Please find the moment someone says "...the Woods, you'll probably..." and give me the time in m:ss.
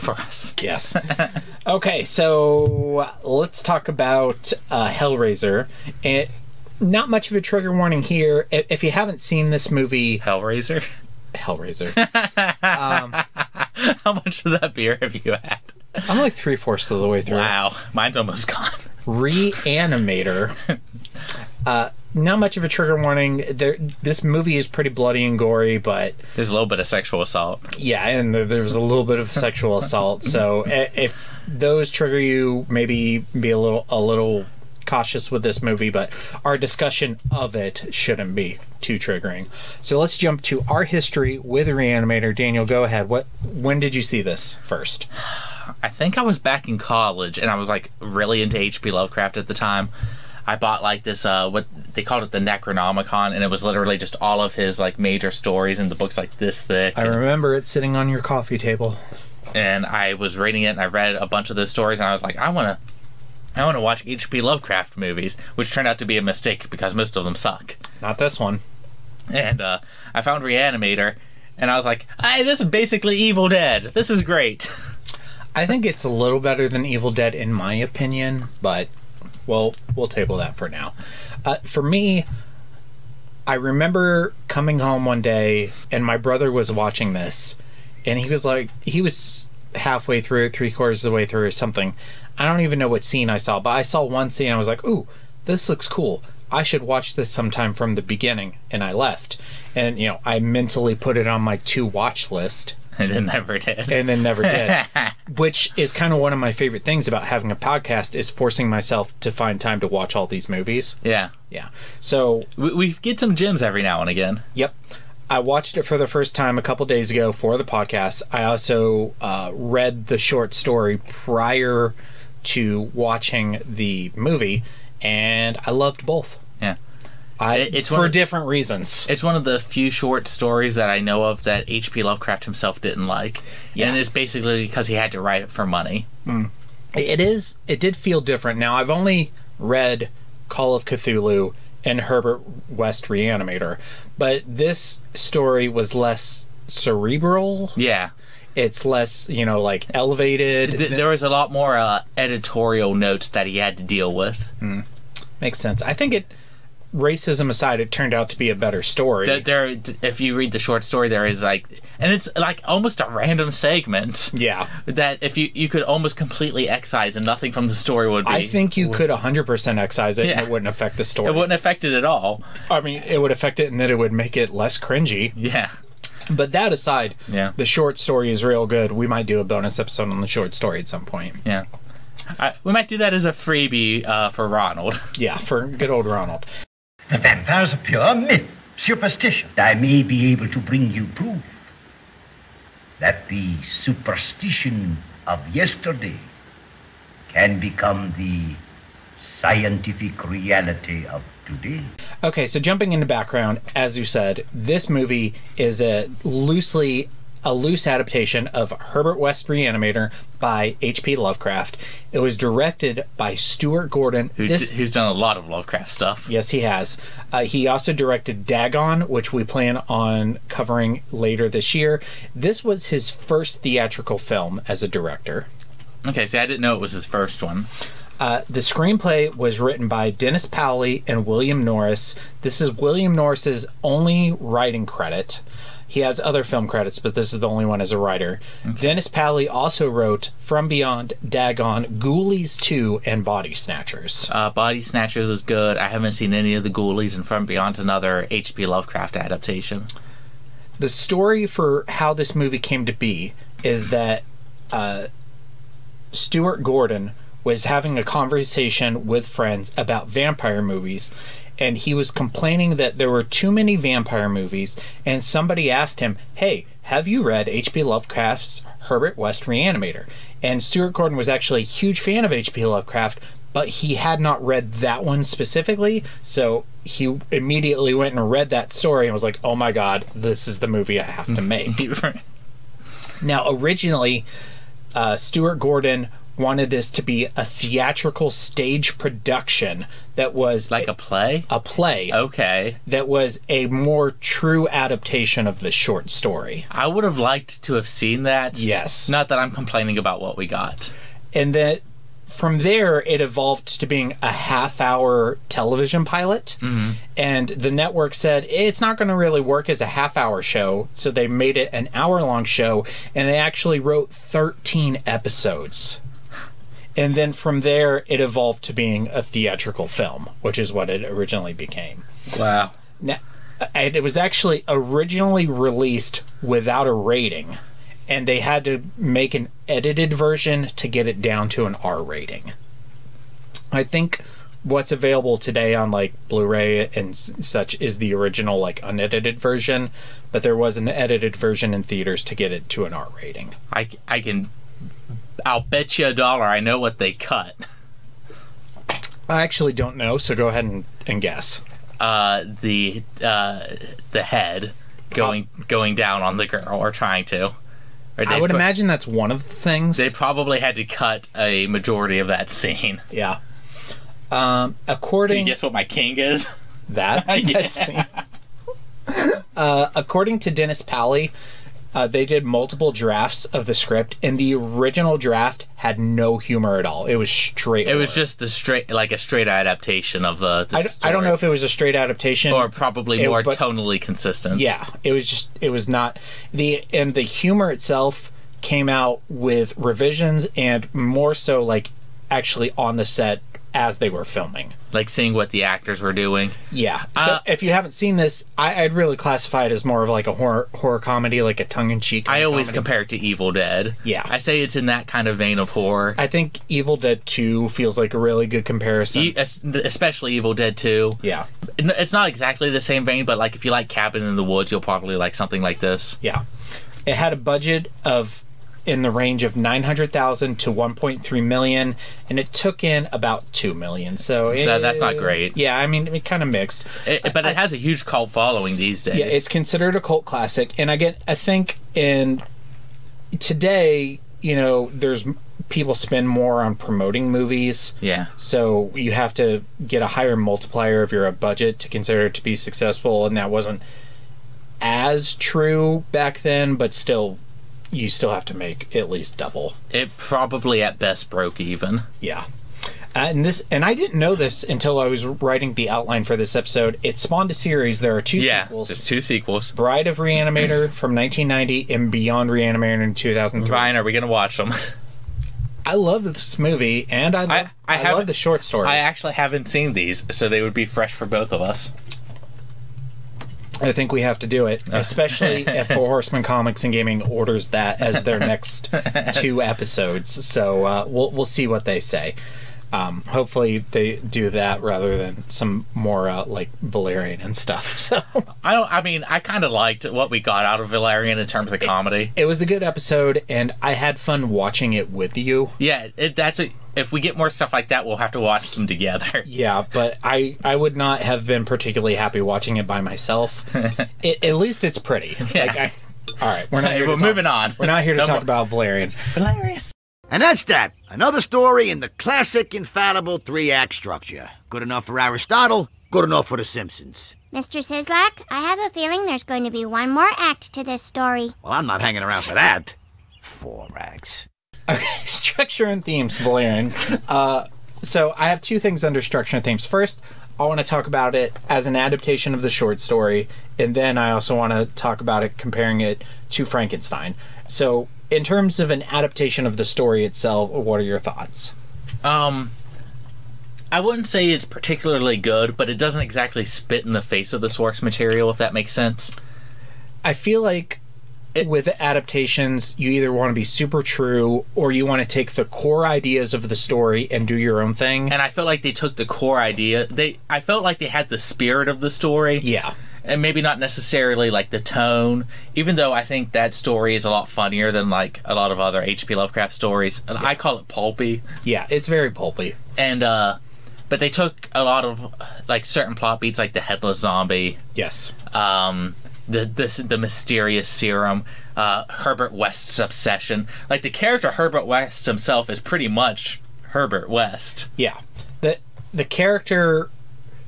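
6:54.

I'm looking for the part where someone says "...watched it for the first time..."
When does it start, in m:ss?
1:55.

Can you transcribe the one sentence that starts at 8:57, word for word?
So, in terms of an adaptation of the story itself, what are your thoughts?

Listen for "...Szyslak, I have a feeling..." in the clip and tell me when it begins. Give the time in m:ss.
8:37.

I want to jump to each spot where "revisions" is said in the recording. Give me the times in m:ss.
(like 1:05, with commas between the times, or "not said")
6:29.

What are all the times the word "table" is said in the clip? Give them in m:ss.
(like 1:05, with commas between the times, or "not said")
0:58, 1:20.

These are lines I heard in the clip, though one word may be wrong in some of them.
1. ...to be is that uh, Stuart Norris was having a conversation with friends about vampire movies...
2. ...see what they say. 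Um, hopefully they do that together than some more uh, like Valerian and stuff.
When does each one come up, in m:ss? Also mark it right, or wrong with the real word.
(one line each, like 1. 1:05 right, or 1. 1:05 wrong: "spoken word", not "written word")
1. 4:12 wrong: "Gordon", not "Norris"
2. 8:01 wrong: "rather", not "together".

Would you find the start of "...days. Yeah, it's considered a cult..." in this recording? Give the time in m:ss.
7:09.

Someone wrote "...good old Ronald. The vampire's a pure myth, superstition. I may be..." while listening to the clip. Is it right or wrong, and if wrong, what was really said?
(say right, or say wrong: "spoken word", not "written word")
right.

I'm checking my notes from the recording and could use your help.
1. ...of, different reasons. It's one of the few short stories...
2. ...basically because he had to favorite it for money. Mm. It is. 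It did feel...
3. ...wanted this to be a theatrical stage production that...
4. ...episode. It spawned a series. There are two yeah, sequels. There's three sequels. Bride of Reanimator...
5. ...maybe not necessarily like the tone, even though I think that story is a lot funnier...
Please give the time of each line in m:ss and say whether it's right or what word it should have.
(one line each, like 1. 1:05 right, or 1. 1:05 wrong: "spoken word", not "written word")
1. 2:08 right
2. 2:14 wrong: "write", not "favorite"
3. 4:46 right
4. 7:36 wrong: "two", not "three"
5. 9:23 right.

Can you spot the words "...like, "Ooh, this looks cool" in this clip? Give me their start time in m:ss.
1:34.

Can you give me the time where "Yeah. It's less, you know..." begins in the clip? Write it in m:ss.
2:27.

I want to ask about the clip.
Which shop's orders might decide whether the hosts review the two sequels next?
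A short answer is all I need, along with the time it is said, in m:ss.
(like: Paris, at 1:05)
Four Horsemen Comics and Gaming, at 7:55.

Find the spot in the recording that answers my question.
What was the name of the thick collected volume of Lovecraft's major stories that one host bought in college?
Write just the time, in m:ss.
0:52.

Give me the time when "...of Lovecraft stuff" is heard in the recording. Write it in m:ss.
3:35.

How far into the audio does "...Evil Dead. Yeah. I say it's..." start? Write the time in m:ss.
6:43.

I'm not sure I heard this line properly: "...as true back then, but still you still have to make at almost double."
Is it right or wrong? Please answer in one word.
wrong.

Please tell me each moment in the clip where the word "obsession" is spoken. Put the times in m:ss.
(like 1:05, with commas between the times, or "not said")
9:42.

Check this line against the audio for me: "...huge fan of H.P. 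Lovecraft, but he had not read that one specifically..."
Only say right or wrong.
right.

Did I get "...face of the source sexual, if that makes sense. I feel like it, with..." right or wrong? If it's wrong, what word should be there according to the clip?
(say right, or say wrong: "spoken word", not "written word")
wrong: "material", not "sexual".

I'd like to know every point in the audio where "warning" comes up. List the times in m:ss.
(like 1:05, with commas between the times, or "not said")
0:07, 0:23.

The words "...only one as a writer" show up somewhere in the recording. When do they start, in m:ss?
3:57.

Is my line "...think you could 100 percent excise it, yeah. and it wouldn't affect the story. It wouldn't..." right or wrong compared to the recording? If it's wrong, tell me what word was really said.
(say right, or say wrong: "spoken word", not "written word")
right.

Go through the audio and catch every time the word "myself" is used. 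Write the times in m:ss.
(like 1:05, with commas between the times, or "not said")
1:48, 8:23.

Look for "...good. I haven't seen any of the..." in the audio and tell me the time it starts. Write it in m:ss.
4:05.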